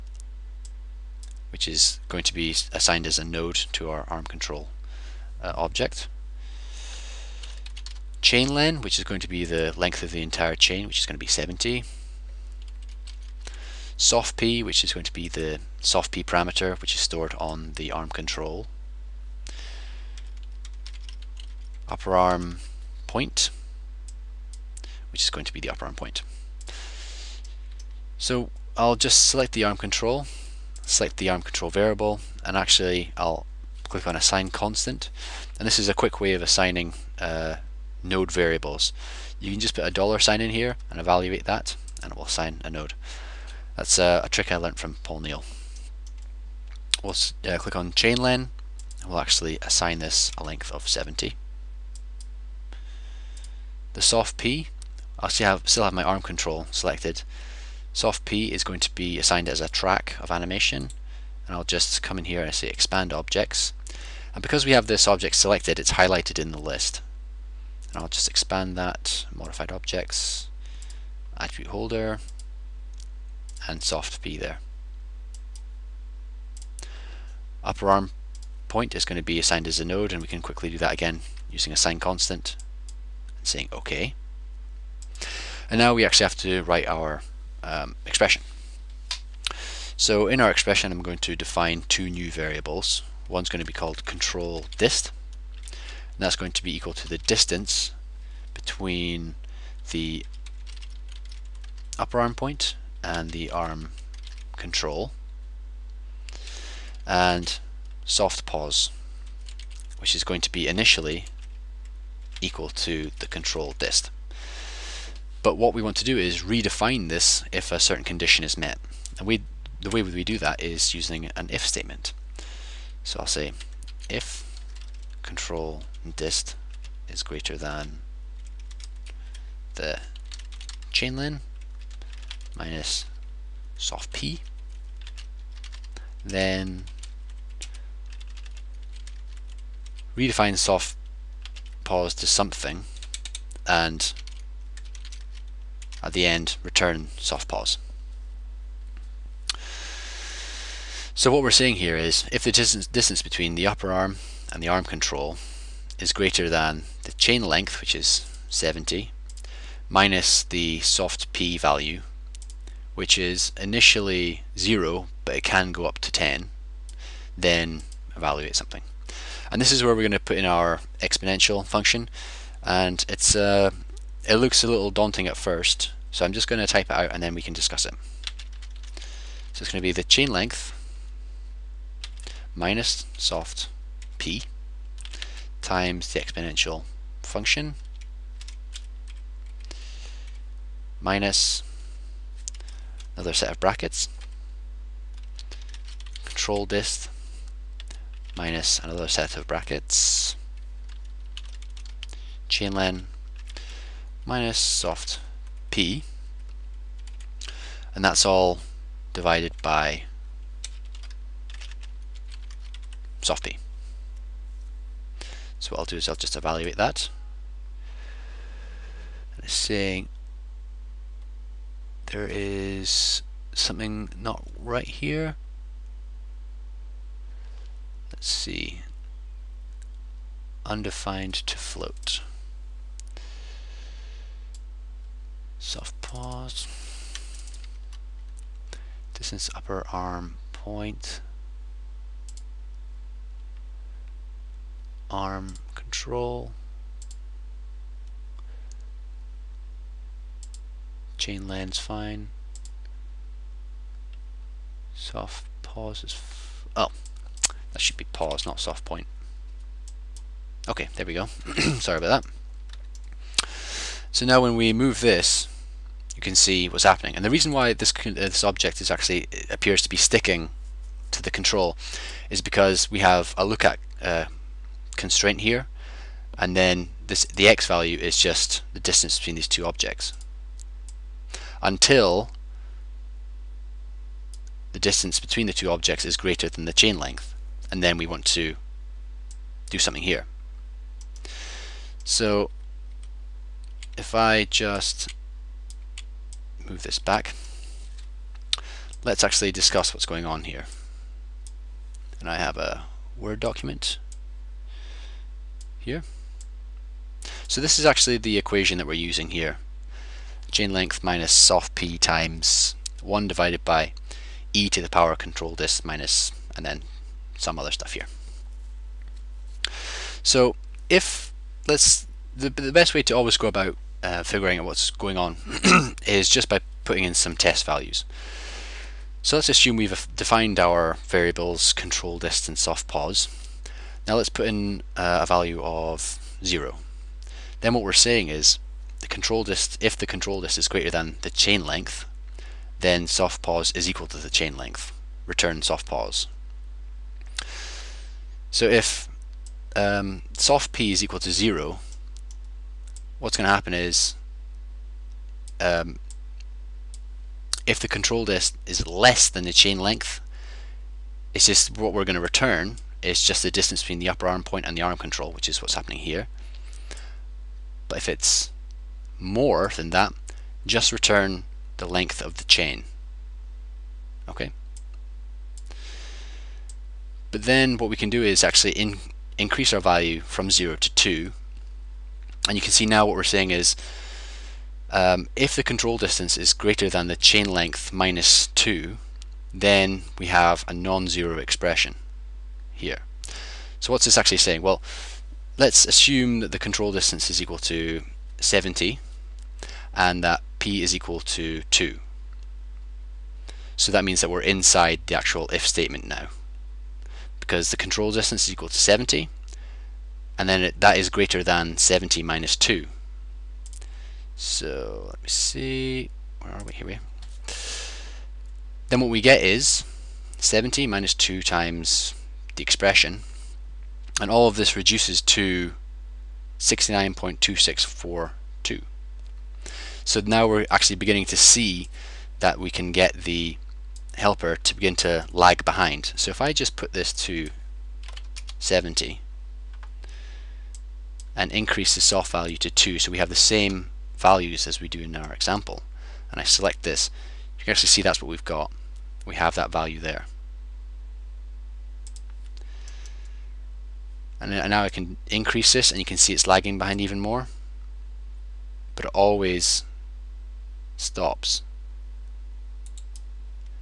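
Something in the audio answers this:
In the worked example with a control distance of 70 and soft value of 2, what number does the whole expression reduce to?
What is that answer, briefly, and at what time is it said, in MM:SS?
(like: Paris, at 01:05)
69.2642, at 07:06.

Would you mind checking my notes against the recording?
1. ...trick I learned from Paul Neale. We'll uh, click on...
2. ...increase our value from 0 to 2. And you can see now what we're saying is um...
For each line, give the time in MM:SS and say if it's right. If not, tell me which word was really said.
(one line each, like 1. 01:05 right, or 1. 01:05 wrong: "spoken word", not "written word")
1. 00:44 right
2. 06:19 right.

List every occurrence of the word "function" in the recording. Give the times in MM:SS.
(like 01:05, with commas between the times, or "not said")
02:51, 03:07.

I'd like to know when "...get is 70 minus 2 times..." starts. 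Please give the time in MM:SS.
06:59.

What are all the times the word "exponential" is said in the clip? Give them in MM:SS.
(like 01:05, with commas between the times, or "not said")
02:50, 03:06.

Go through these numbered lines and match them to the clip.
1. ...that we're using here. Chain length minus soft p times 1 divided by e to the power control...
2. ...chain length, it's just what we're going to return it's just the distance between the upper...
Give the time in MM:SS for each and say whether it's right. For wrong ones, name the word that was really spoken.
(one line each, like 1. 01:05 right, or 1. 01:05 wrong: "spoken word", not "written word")
1. 05:08 right
2. 05:59 right.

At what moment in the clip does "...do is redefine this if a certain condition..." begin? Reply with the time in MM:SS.
01:56.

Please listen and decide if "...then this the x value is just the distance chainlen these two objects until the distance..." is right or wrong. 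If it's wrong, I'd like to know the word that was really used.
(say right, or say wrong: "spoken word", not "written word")
wrong: "between", not "chainlen".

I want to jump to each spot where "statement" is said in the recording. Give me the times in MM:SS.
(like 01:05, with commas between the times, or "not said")
02:01, 06:45.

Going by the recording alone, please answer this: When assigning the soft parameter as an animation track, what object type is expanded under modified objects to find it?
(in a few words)
attribute holder.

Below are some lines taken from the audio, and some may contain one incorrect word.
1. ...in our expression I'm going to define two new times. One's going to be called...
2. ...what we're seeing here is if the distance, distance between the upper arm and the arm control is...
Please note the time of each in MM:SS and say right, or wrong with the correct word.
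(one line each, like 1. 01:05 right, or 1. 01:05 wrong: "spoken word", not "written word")
1. 01:30 wrong: "variables", not "times"
2. 02:31 right.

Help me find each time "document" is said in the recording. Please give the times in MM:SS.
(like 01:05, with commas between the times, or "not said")
05:03.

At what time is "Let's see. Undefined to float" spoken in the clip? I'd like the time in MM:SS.
03:48.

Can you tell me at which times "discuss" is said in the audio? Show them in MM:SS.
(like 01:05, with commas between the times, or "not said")
02:57, 04:59.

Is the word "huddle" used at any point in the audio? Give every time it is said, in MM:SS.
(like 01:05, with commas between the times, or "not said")
not said.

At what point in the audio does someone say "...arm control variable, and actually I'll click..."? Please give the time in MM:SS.
00:31.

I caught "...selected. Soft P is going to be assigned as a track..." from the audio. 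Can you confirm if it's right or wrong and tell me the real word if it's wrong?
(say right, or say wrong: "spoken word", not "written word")
right.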